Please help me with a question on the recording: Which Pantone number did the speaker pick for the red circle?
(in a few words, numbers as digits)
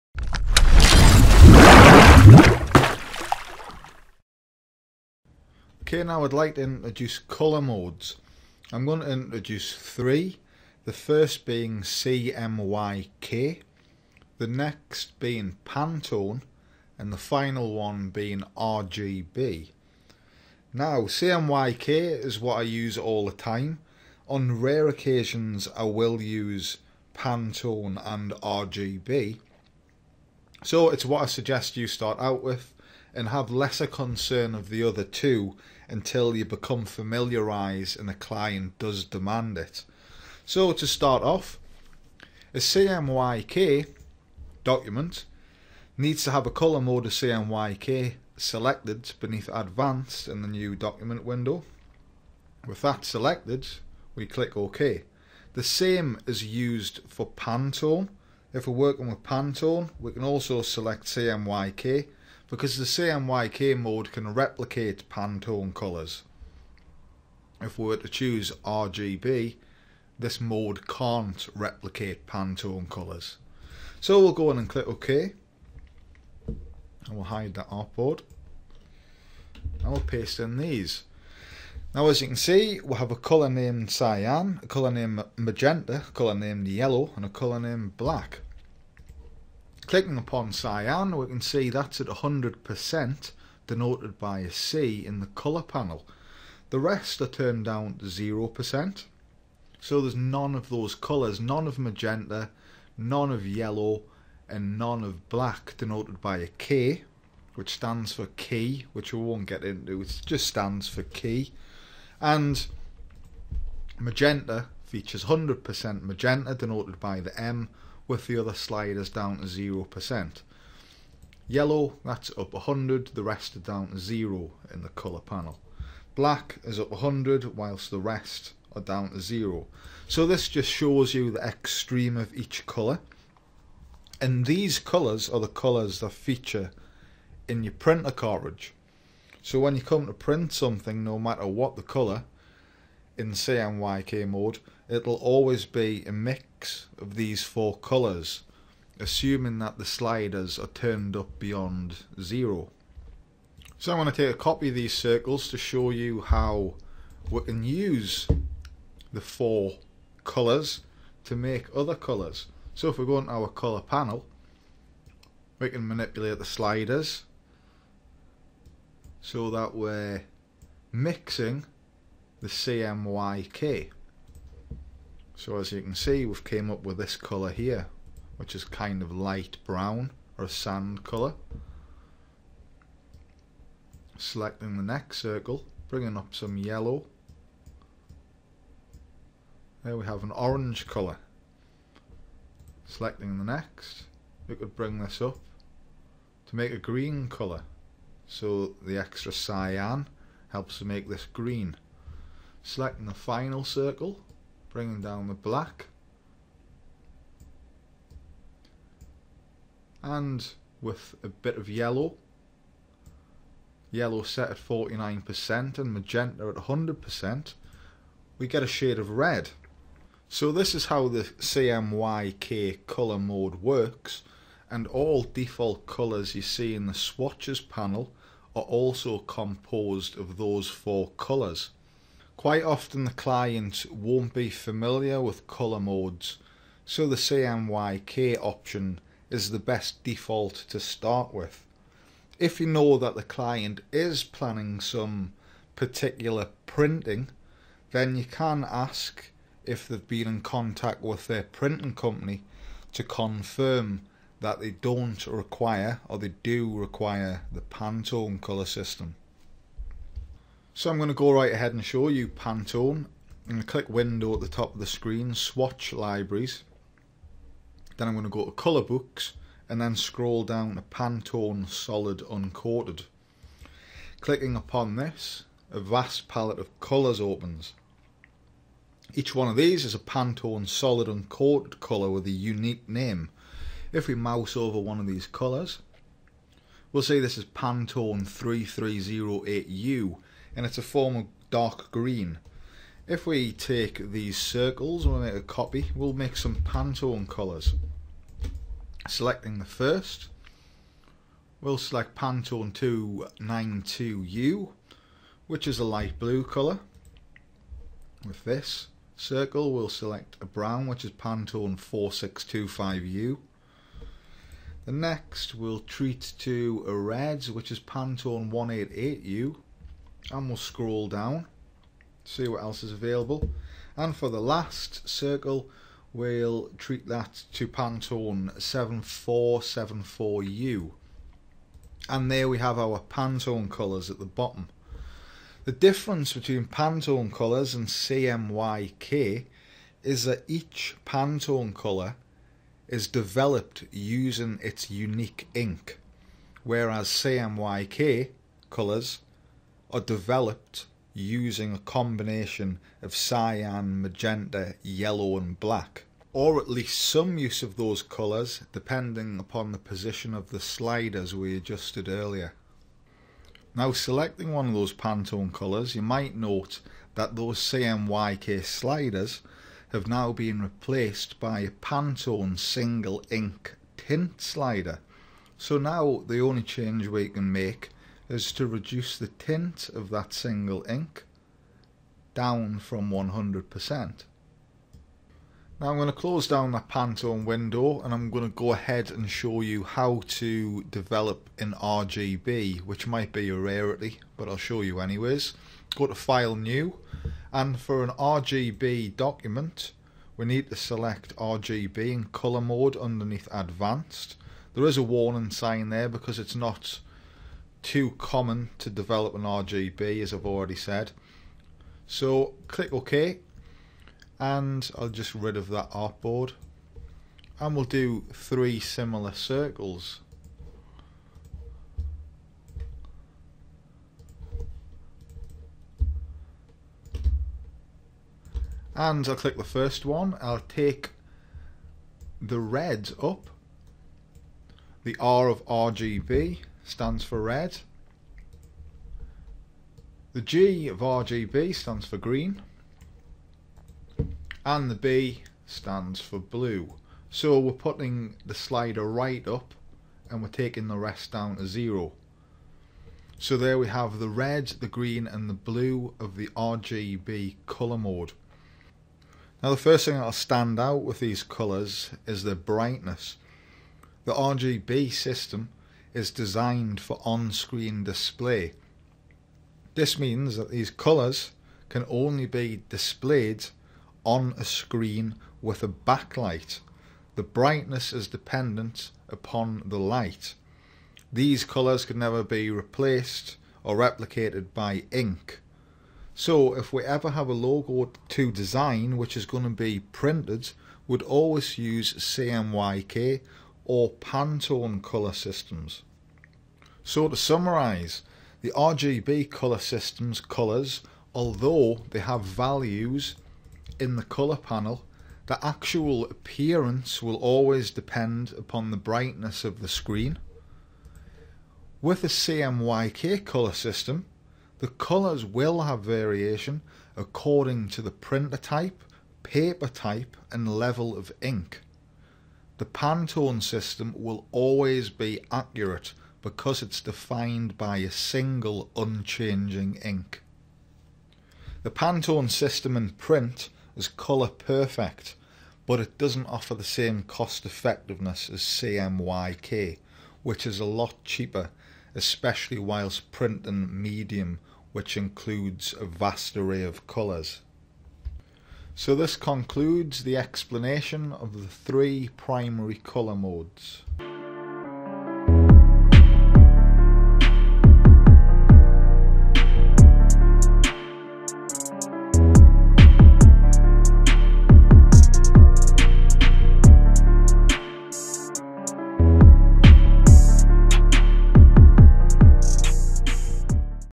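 Pantone 188U.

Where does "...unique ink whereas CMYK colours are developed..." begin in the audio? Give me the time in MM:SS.
05:44.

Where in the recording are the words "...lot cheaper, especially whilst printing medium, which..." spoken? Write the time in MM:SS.
09:00.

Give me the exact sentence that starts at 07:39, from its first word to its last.
Now the first thing that'll stand out with these colours is the brightness.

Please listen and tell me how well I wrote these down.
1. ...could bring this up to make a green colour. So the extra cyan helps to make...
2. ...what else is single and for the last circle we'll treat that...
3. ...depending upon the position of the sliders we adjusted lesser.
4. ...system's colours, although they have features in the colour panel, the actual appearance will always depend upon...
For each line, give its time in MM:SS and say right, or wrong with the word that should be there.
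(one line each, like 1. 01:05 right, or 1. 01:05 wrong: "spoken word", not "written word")
1. 03:14 right
2. 05:22 wrong: "available", not "single"
3. 05:58 wrong: "earlier", not "lesser"
4. 08:19 wrong: "values", not "features".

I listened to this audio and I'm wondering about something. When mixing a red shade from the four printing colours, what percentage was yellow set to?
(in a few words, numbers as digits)
49%.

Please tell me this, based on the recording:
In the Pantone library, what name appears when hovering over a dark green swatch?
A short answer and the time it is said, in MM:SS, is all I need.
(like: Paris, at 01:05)
Pantone 3308U, at 04:47.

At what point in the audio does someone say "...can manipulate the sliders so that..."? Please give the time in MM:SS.
02:45.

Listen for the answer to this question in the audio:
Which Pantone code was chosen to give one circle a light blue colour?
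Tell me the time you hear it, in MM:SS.
05:02.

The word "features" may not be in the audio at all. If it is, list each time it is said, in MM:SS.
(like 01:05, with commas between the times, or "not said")
01:54, 02:16.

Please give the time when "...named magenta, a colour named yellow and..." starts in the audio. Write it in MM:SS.
01:24.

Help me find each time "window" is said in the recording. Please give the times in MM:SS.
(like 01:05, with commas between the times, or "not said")
00:51, 04:23, 06:27.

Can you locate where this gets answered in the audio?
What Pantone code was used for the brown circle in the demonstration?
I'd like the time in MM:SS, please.
05:11.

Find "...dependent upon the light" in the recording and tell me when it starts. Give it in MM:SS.
07:58.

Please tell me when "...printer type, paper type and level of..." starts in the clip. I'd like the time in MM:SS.
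08:38.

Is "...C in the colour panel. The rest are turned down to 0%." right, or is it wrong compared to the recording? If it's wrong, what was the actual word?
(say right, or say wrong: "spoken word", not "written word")
right.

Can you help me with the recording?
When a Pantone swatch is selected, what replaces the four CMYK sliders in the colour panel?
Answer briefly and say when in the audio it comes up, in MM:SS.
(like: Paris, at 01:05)
Single ink tint slider, at 06:12.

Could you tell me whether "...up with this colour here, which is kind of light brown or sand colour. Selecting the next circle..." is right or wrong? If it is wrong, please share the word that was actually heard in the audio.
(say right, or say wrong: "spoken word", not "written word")
right.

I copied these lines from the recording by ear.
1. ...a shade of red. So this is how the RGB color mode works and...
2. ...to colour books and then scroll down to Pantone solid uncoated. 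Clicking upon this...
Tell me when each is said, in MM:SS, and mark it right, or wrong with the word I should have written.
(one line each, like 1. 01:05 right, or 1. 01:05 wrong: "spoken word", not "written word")
1. 03:38 wrong: "CMYK", not "RGB"
2. 04:28 right.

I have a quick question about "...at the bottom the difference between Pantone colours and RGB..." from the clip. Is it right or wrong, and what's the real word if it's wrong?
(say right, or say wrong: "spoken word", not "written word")
wrong: "CMYK", not "RGB".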